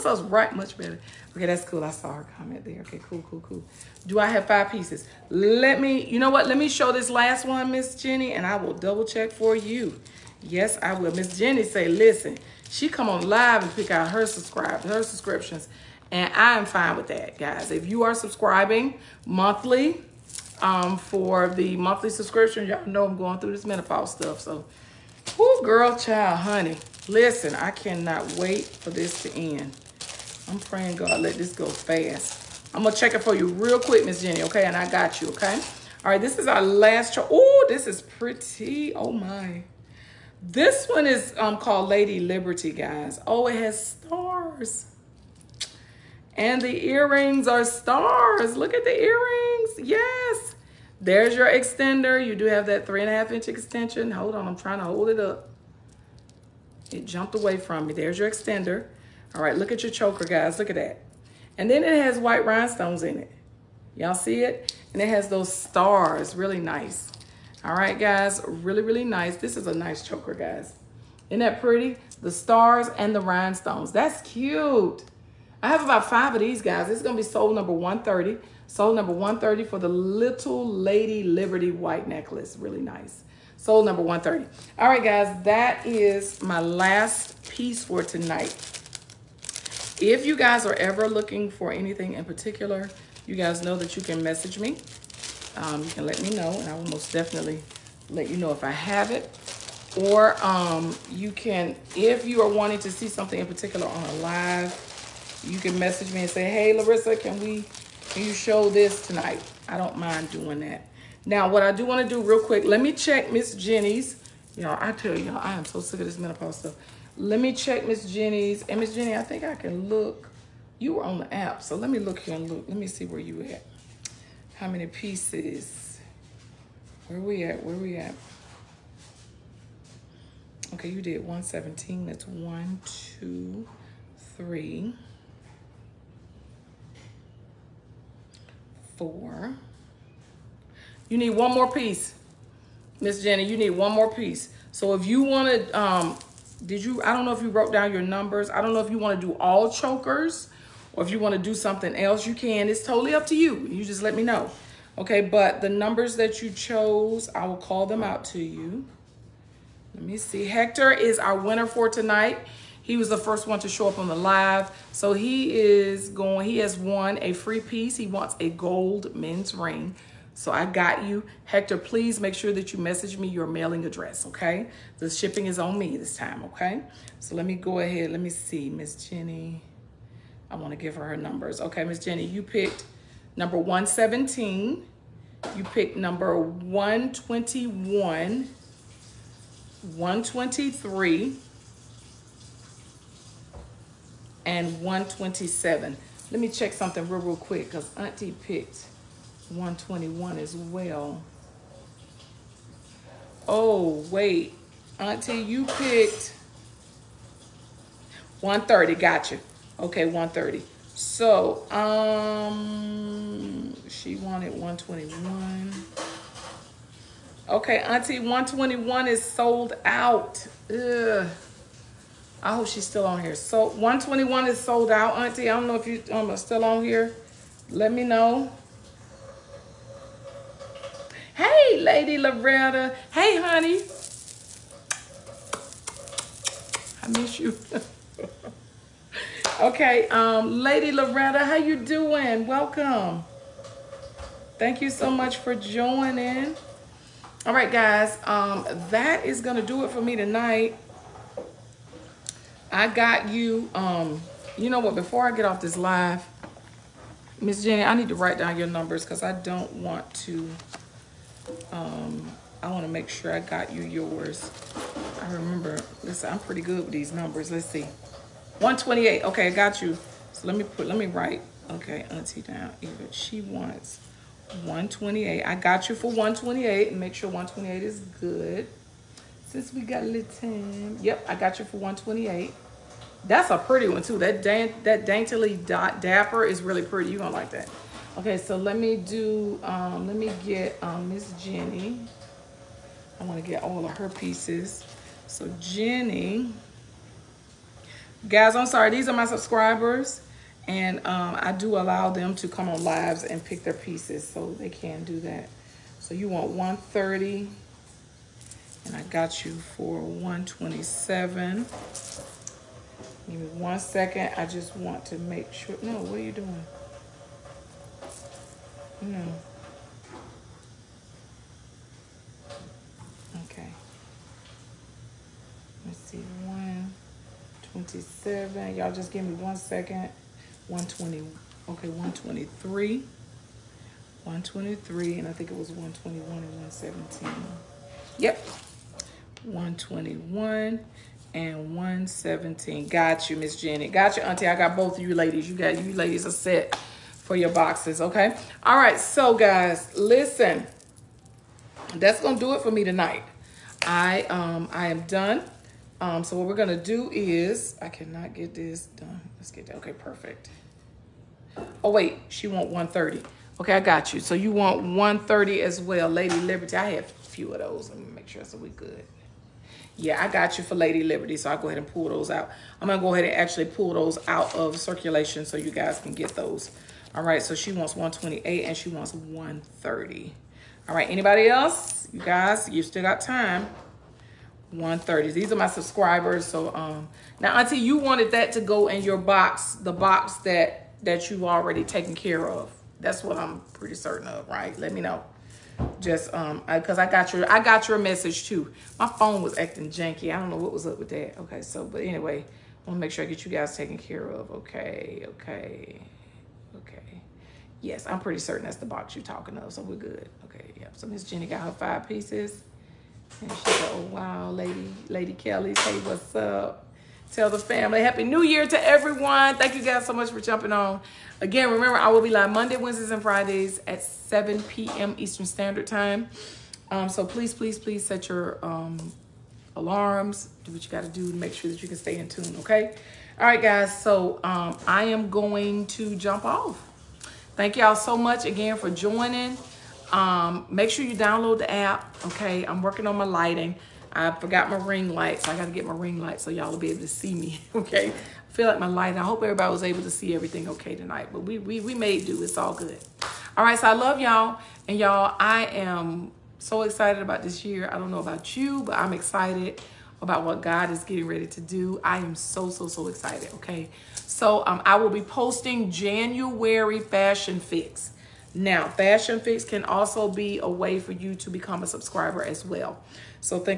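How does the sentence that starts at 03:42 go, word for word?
I hope she's still on here.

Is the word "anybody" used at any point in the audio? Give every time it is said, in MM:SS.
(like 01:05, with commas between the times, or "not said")
06:21.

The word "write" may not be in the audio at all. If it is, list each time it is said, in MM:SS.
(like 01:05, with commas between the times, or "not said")
04:18, 04:31.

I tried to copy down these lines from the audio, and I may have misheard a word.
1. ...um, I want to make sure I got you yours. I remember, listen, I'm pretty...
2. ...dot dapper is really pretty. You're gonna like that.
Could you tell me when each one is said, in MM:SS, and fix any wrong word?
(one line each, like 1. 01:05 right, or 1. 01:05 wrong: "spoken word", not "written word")
1. 04:21 right
2. 04:45 right.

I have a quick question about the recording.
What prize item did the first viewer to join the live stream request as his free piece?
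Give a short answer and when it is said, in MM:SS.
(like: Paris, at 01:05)
gold men's ring, at 02:48.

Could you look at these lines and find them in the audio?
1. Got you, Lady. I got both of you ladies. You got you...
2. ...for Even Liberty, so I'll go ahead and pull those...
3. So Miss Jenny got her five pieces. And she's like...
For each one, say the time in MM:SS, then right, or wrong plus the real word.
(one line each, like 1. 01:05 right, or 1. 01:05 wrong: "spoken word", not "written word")
1. 05:43 wrong: "Auntie", not "Lady"
2. 06:10 wrong: "Lady", not "Even"
3. 06:50 right.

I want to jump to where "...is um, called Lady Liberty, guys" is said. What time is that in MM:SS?
00:41.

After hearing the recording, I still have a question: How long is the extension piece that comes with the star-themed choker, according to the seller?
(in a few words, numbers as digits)
3.5 inch.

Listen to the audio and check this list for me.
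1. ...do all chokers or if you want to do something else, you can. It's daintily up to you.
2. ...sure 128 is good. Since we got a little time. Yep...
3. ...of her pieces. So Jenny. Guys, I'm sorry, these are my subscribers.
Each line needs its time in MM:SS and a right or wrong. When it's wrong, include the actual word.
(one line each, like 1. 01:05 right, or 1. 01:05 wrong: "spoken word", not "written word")
1. 02:29 wrong: "totally", not "daintily"
2. 04:37 right
3. 04:53 right.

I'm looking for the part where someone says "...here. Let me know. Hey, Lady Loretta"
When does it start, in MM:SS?
03:46.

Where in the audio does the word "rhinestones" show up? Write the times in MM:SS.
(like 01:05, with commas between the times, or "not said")
01:02, 01:13.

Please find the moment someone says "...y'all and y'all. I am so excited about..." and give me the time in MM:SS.
07:34.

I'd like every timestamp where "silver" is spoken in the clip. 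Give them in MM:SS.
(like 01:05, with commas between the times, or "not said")
not said.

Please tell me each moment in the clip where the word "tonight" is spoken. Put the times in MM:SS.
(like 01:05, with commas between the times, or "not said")
01:28, 01:49, 02:41, 04:10, 05:52, 07:30.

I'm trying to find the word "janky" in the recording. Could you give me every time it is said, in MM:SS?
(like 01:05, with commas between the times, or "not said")
06:39.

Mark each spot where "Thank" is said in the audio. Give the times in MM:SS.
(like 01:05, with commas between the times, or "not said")
04:04, 06:59, 07:17.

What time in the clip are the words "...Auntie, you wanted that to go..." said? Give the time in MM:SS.
06:27.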